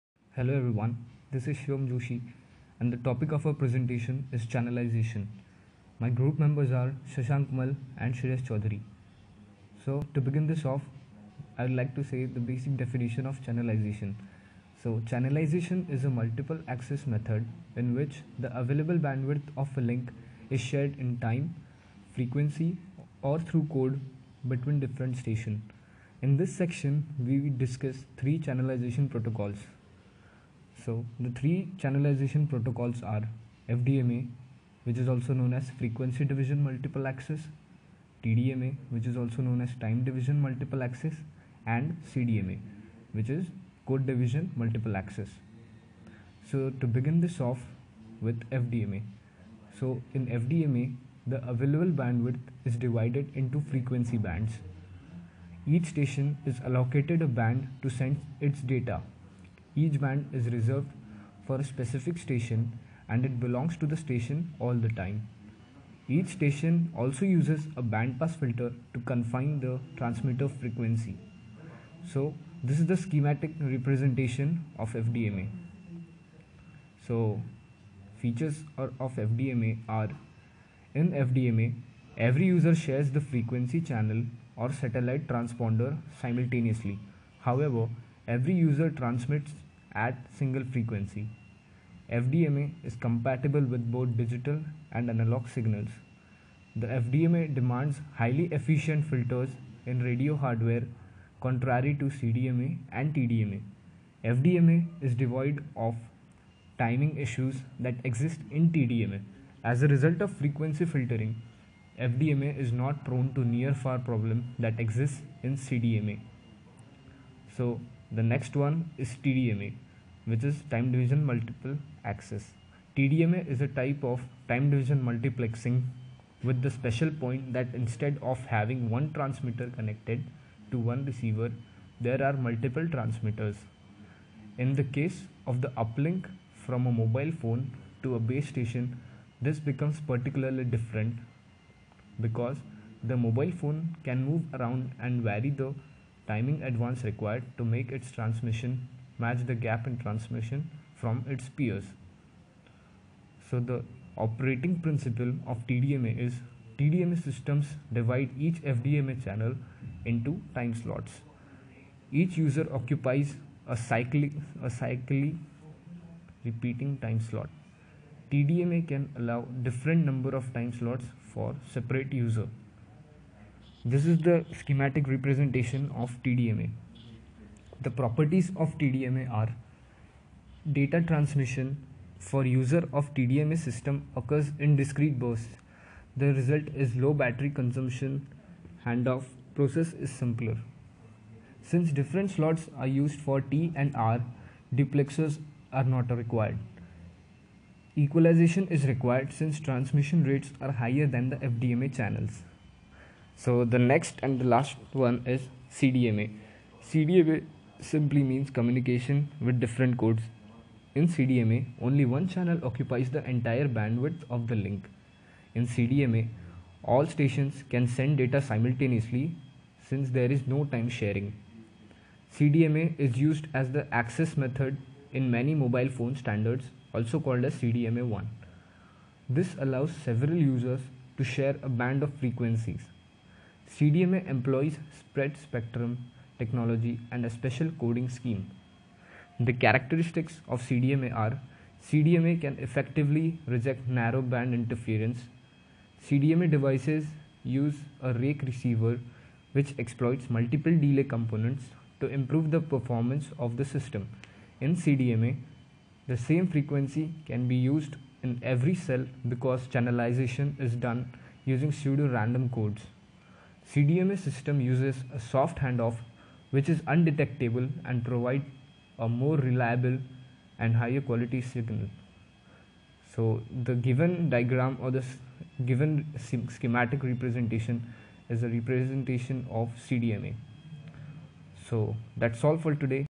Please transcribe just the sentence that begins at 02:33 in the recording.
So the operating principle of TDMA is TDMA systems divide each FDMA channel into time slots.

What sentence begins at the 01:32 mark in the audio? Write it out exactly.
FDMA is compatible with both digital and analog signals.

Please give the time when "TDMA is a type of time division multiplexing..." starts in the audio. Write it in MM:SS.
02:02.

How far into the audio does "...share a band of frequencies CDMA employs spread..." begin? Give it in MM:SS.
03:51.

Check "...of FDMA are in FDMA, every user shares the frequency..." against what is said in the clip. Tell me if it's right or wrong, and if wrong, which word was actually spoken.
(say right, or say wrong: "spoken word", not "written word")
right.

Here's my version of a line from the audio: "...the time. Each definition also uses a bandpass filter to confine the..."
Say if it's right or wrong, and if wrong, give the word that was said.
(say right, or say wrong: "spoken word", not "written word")
wrong: "station", not "definition".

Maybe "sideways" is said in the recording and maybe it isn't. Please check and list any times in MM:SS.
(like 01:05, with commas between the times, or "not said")
not said.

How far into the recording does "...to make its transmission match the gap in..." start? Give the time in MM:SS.
02:27.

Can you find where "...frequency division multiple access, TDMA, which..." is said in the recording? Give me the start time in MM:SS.
00:35.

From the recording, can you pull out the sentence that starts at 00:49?
So in FDMA, the available bandwidth is divided into frequency bands.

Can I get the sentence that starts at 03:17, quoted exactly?
Equalization is required since transmission rates are higher than the FDMA channels.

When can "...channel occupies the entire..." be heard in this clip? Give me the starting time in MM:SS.
03:32.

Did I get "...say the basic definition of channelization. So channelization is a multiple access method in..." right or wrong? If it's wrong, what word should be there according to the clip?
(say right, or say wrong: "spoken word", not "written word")
right.